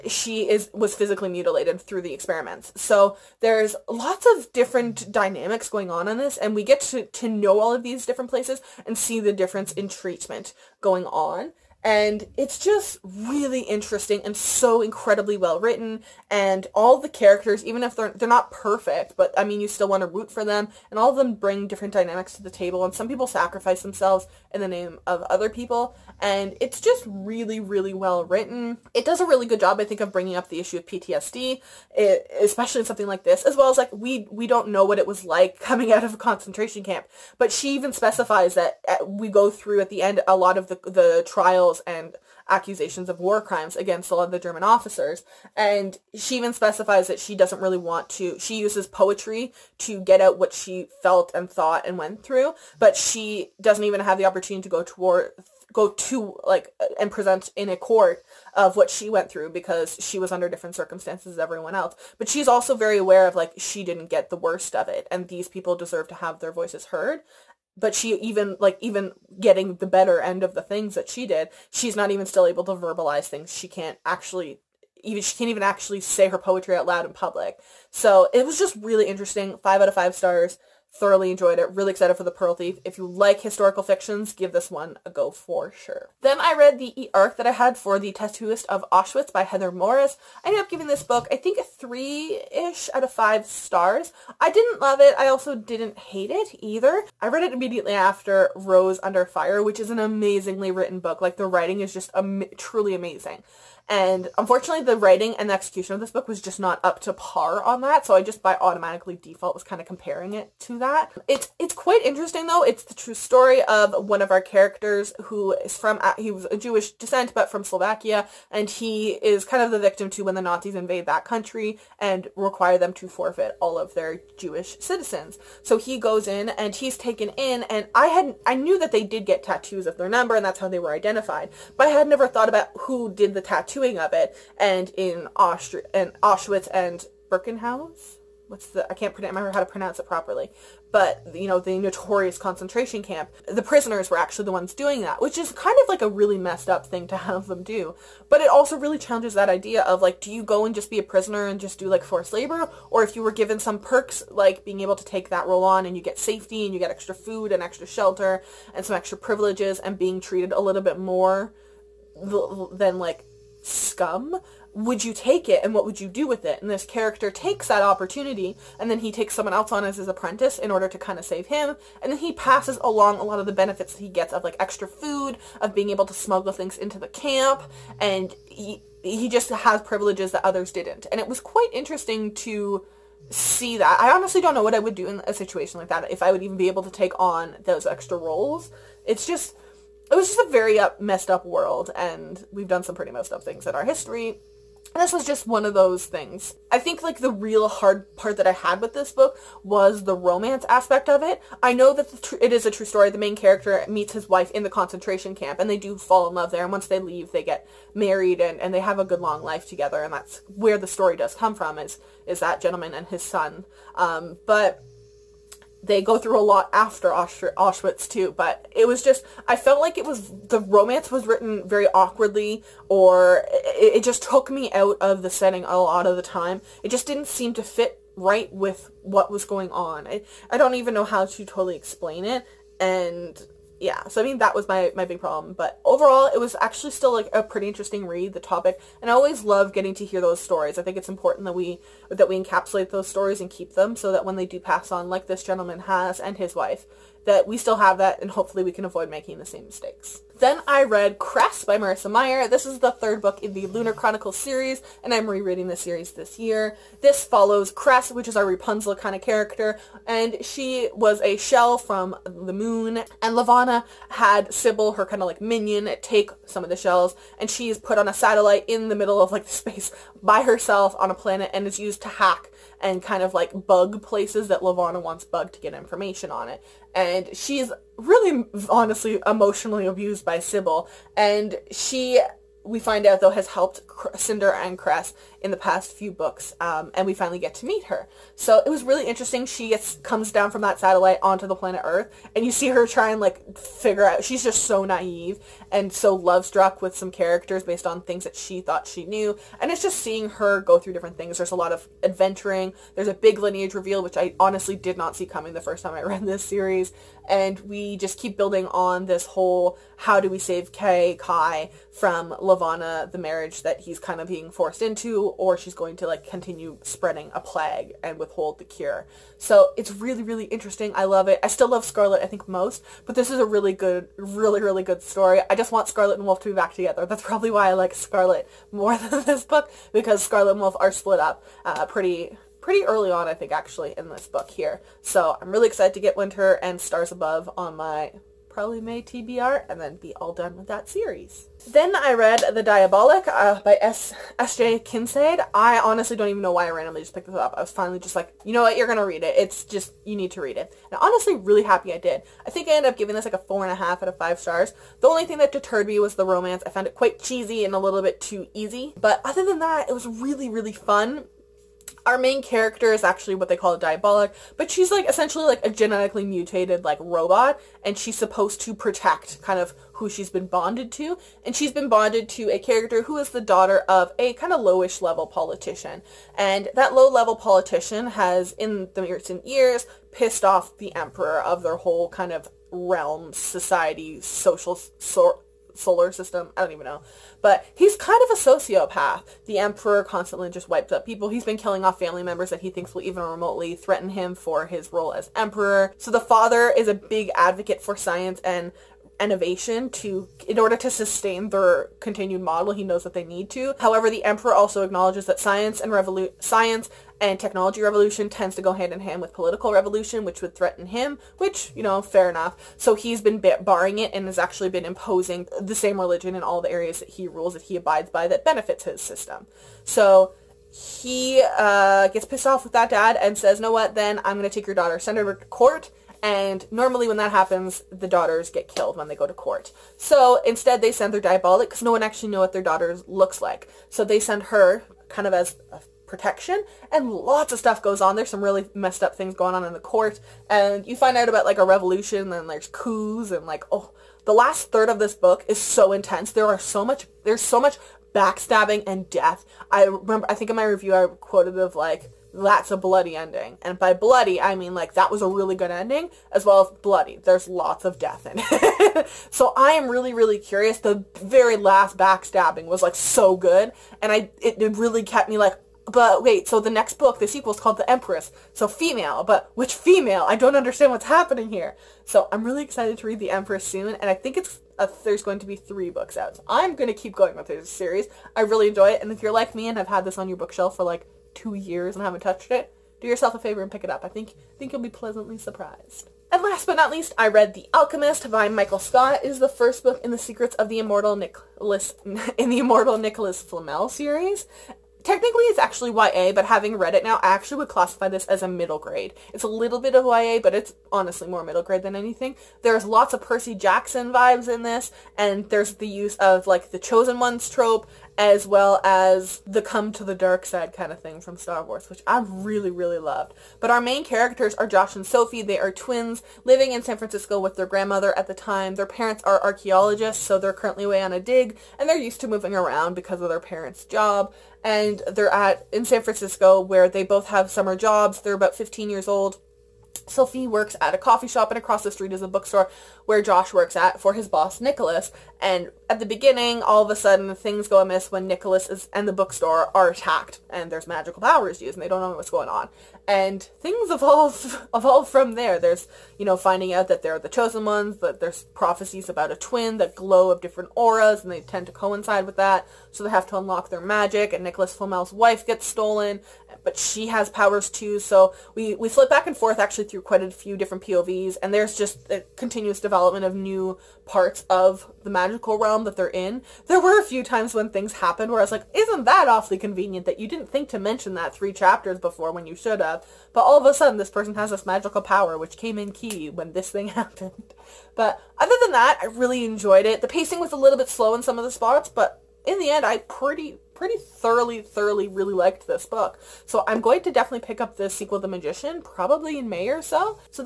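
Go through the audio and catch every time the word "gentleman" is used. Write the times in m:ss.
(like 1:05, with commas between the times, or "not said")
3:32, 4:05.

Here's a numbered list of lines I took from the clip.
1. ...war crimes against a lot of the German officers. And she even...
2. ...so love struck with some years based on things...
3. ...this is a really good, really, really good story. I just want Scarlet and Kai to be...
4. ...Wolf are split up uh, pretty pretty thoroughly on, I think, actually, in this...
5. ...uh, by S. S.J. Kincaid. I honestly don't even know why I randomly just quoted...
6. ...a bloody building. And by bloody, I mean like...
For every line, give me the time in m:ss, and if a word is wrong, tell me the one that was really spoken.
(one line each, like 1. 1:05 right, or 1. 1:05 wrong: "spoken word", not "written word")
1. 0:43 right
2. 4:55 wrong: "characters", not "years"
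3. 5:23 wrong: "Wolf", not "Kai"
4. 5:30 wrong: "early", not "thoroughly"
5. 5:43 wrong: "picked", not "quoted"
6. 7:32 wrong: "ending", not "building".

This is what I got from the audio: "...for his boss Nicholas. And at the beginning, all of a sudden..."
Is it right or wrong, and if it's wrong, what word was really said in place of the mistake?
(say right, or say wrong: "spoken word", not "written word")
right.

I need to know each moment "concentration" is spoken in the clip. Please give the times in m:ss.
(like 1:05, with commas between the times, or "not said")
0:36, 2:22, 3:24.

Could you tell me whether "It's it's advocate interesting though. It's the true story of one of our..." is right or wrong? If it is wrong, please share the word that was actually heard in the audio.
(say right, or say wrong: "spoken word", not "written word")
wrong: "quite", not "advocate".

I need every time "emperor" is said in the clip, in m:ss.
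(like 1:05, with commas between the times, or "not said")
6:20, 6:29, 6:35, 6:44.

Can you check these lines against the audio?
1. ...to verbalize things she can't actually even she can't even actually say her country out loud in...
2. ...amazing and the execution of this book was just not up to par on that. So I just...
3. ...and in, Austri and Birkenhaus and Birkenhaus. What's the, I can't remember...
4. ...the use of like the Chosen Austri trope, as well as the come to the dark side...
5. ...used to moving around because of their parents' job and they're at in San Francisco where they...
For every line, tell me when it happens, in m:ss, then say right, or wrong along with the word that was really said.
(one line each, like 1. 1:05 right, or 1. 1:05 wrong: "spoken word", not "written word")
1. 1:12 wrong: "poetry", not "country"
2. 1:44 wrong: "writing", not "amazing"
3. 2:14 wrong: "Auschwitz", not "Birkenhaus"
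4. 8:25 wrong: "Ones", not "Austri"
5. 8:41 right.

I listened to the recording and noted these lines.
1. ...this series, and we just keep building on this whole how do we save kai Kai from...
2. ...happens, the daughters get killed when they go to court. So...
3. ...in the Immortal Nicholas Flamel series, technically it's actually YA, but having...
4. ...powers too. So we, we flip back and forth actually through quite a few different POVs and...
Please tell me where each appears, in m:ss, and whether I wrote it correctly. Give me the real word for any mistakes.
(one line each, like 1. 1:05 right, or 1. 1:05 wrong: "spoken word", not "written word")
1. 5:06 right
2. 7:07 right
3. 8:12 right
4. 9:17 right.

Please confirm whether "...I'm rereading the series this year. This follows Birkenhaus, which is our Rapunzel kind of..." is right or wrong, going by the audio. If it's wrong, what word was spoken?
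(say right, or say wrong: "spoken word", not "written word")
wrong: "Cress", not "Birkenhaus".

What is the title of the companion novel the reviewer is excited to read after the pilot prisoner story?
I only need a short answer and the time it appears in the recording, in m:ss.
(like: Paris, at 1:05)
The Pearl Thief, at 1:22.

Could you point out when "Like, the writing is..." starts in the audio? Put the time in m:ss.
1:41.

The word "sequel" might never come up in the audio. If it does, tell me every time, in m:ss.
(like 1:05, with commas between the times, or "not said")
7:47, 9:47.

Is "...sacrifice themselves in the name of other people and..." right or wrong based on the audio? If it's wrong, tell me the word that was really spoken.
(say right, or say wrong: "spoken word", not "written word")
right.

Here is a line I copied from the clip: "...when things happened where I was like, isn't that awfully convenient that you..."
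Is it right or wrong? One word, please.
right.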